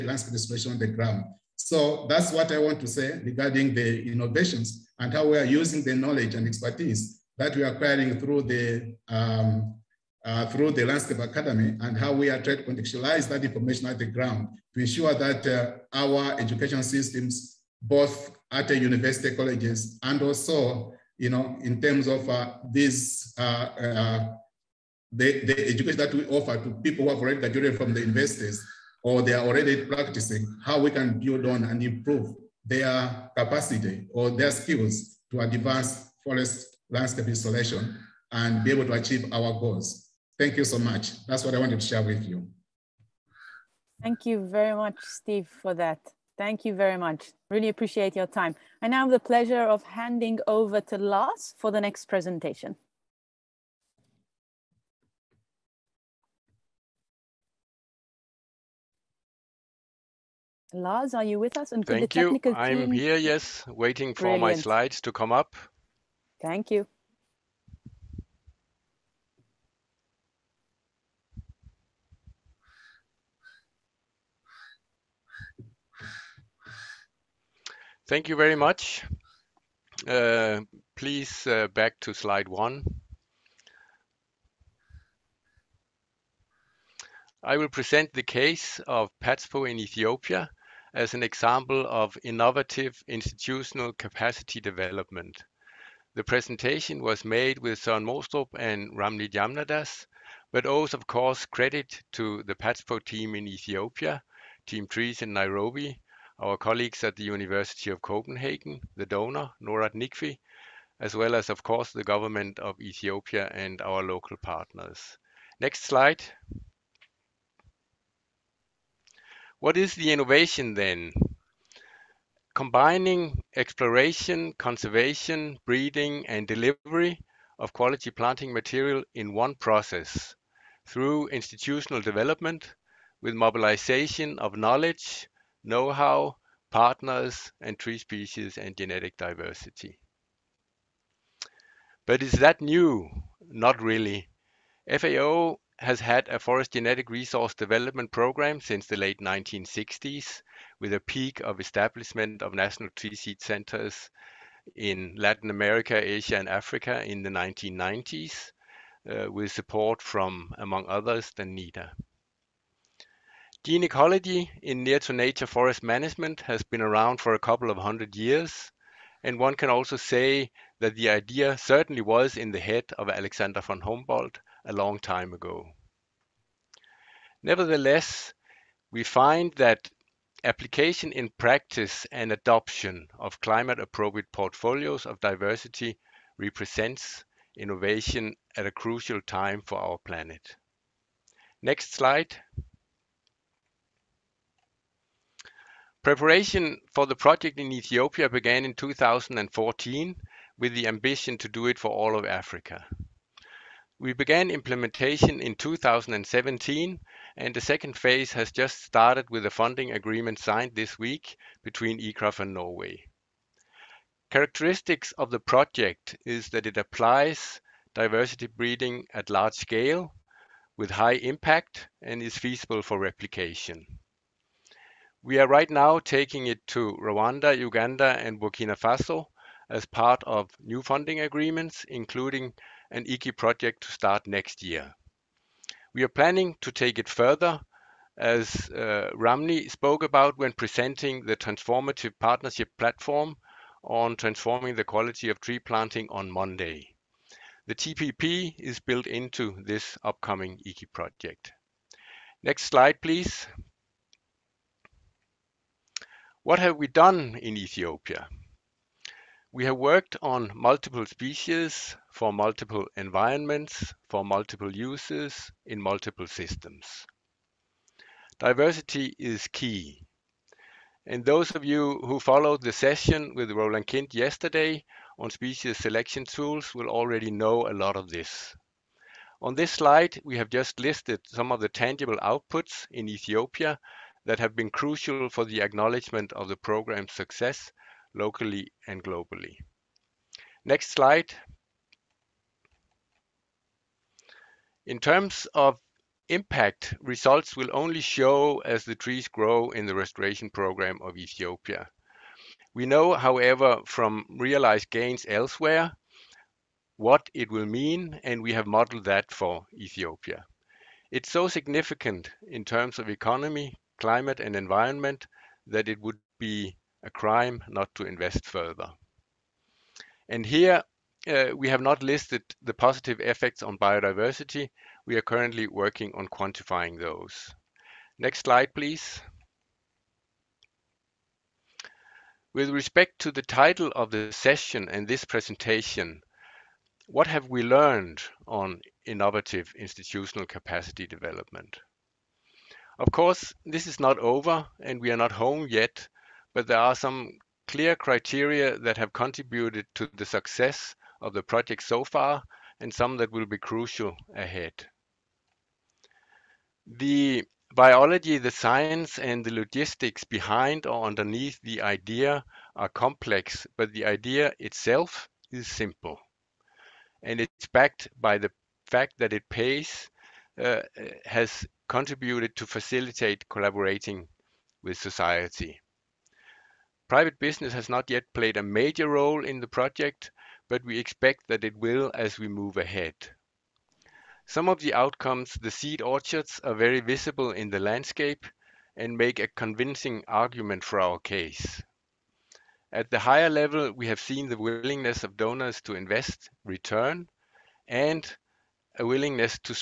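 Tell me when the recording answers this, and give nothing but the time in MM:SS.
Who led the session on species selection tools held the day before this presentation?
04:33.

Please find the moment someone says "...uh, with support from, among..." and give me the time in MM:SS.
02:39.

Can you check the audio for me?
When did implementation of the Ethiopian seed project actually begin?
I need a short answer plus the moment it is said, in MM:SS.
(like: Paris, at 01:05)
2017, at 03:25.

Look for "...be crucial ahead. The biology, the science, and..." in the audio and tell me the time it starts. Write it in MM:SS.
05:53.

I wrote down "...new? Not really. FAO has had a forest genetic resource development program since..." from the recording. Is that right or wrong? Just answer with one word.
right.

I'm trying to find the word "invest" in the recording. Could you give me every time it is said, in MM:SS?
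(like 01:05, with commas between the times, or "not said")
05:18, 06:35.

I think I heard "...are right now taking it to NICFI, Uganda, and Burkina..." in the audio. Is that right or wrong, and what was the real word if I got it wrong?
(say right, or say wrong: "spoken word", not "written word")
wrong: "Rwanda", not "NICFI".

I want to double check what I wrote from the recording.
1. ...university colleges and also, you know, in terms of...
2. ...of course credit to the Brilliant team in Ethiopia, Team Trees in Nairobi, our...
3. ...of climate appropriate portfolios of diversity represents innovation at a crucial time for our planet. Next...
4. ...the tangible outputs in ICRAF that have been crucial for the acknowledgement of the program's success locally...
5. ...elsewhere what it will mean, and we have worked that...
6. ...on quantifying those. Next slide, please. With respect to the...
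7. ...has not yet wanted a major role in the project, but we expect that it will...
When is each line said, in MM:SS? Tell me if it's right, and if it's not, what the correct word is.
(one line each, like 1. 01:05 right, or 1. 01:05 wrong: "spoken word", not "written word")
1. 00:18 right
2. 01:40 wrong: "PATSPO", not "Brilliant"
3. 03:03 right
4. 04:41 wrong: "Ethiopia", not "ICRAF"
5. 05:05 wrong: "modeled", not "worked"
6. 05:26 right
7. 06:17 wrong: "played", not "wanted".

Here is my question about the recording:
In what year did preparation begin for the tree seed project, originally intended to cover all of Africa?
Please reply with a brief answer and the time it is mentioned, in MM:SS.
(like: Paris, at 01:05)
2014, at 03:18.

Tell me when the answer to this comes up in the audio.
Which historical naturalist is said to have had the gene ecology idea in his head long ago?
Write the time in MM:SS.
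02:53.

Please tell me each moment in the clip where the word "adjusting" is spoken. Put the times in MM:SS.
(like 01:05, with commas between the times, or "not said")
not said.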